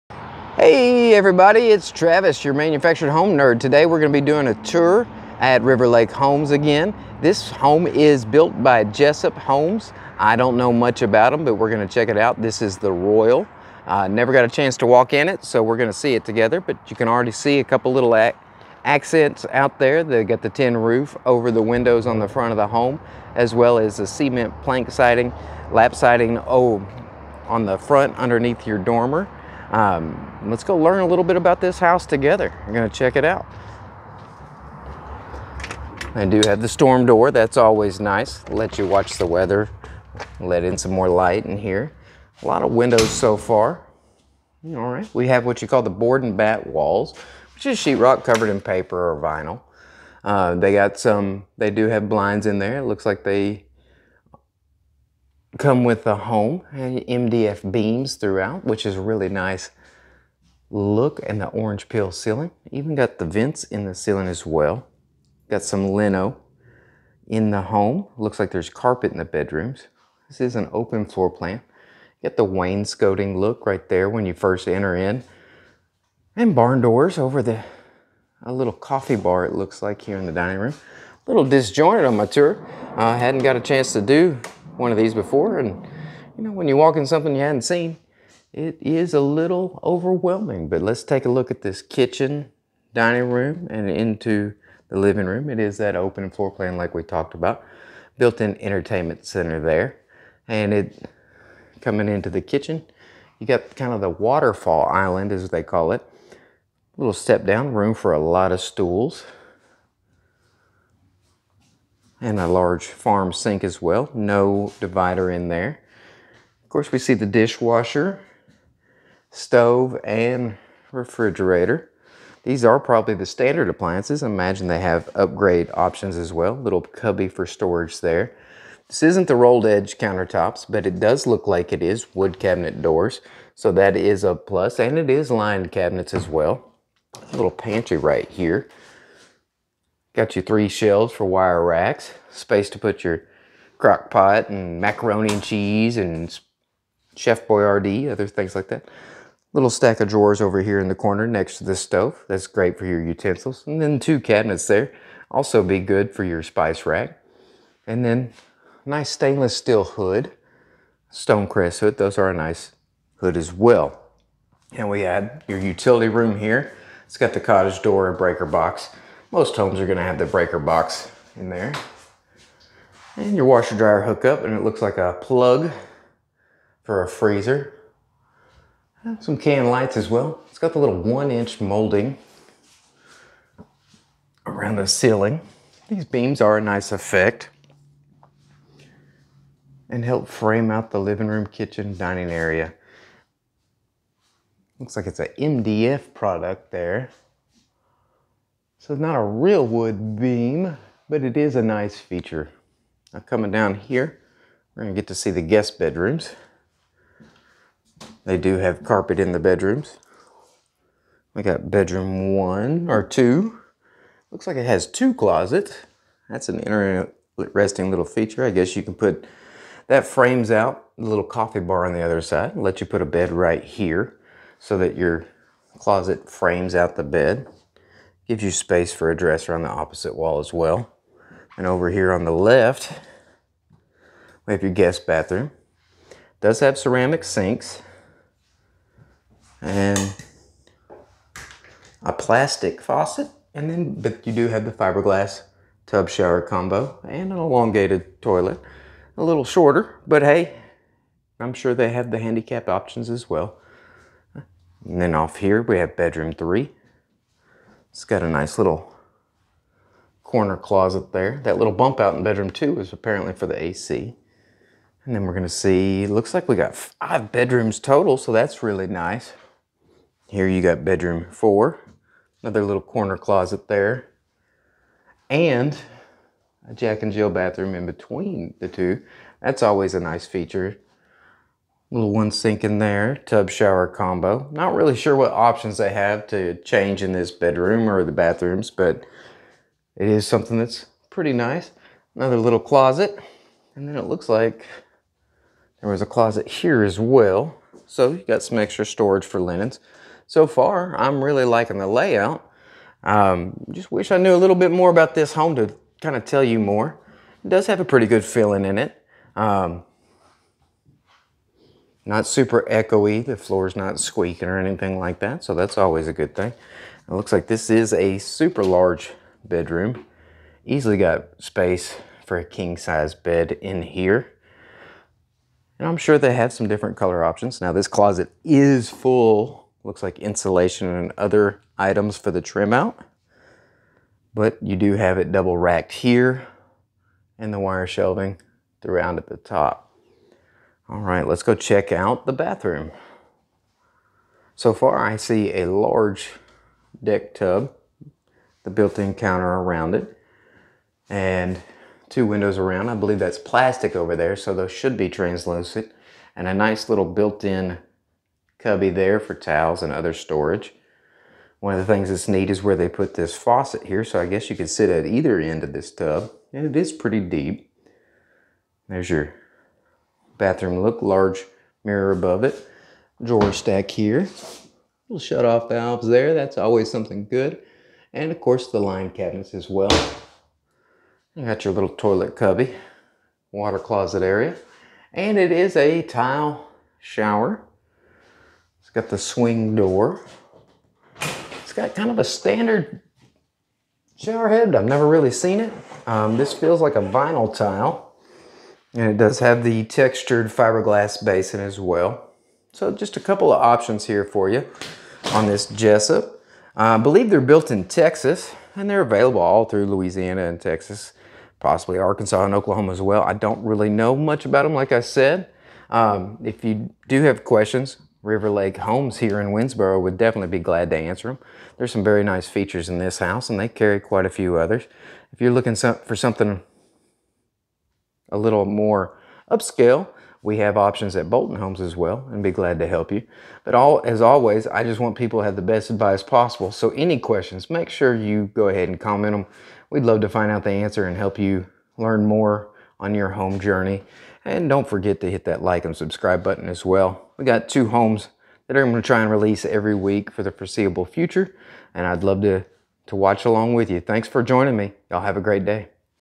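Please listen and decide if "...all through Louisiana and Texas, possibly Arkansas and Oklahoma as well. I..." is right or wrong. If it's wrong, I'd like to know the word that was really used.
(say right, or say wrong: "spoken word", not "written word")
right.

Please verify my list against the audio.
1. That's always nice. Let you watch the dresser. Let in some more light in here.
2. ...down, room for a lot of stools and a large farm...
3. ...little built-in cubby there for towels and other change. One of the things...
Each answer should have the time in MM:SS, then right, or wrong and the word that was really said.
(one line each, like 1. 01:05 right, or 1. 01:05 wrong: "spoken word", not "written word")
1. 00:37 wrong: "weather", not "dresser"
2. 01:47 right
3. 05:56 wrong: "storage", not "change".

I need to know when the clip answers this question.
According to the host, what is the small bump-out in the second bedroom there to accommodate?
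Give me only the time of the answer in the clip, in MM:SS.
04:23.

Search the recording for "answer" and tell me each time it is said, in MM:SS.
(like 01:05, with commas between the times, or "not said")
07:00, 07:20.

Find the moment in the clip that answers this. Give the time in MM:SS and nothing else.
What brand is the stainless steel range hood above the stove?
02:41.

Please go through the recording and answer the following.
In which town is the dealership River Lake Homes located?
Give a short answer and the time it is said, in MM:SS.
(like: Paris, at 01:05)
Winnsboro, at 06:59.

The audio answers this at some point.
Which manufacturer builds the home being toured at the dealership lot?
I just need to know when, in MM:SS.
00:08.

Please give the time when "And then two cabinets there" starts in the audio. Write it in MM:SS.
02:33.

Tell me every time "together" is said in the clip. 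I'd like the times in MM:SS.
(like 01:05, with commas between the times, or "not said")
00:16, 00:32.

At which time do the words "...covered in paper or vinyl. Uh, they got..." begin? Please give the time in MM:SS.
00:48.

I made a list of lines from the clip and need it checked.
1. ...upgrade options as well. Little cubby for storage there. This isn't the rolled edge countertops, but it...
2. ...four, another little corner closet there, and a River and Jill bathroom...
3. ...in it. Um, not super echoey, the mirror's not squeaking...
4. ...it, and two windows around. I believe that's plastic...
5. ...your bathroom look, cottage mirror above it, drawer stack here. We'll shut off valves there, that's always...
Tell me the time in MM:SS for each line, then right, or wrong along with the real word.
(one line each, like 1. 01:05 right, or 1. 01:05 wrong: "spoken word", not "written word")
1. 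02:05 right
2. 04:31 wrong: "Jack", not "River"
3. 05:08 wrong: "floor", not "mirror"
4. 05:49 right
5. 06:09 wrong: "large", not "cottage".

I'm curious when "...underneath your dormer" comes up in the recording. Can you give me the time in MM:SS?
00:28.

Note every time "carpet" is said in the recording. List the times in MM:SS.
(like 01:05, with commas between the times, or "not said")
01:08, 03:28.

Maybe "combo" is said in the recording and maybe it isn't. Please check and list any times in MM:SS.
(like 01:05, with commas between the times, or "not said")
04:06, 04:43.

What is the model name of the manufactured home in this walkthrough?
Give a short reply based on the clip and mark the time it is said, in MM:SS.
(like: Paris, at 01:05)
The Royal, at 00:12.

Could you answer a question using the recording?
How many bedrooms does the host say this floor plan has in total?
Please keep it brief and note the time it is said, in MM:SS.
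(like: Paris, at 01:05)
5, at 04:26.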